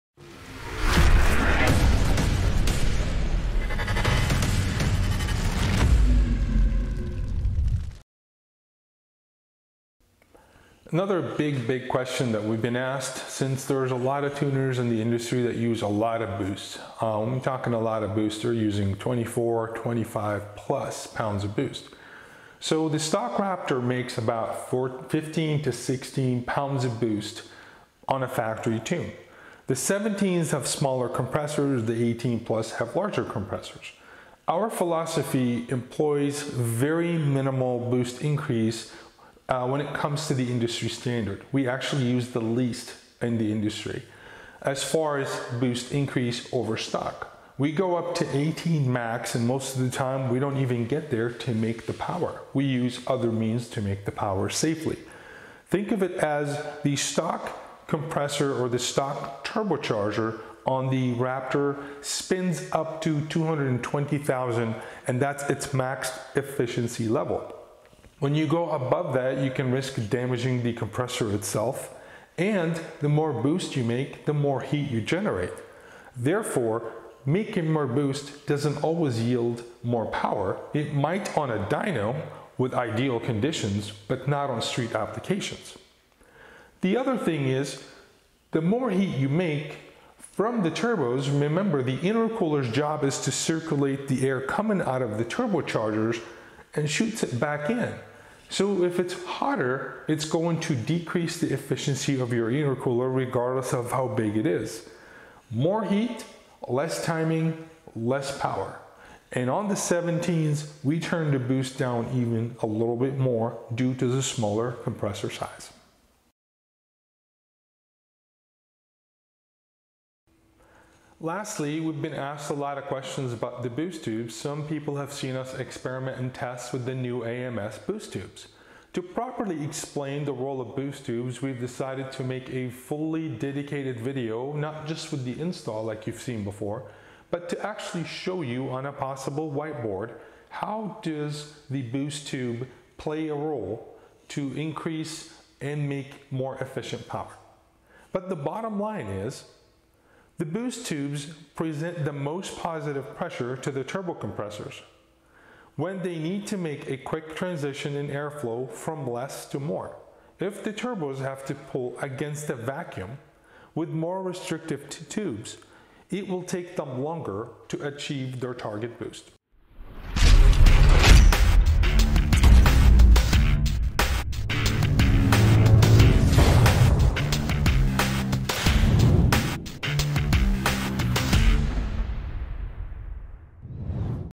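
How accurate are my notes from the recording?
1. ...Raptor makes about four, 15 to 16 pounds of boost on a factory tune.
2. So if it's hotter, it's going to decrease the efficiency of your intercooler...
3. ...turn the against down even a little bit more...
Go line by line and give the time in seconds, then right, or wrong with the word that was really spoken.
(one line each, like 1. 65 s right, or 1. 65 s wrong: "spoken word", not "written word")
1. 23 s right
2. 98 s right
3. 110 s wrong: "boost", not "against".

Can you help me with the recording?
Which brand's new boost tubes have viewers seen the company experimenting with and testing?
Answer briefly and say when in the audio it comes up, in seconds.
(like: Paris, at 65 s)
AMS, at 127 s.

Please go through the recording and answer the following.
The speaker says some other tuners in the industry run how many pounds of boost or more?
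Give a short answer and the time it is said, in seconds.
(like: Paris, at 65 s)
24 to 25, at 18 s.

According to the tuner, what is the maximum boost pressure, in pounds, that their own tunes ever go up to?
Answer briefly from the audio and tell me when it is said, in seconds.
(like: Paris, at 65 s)
18, at 48 s.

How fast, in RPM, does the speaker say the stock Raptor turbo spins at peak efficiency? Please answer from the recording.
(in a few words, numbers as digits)
220,000.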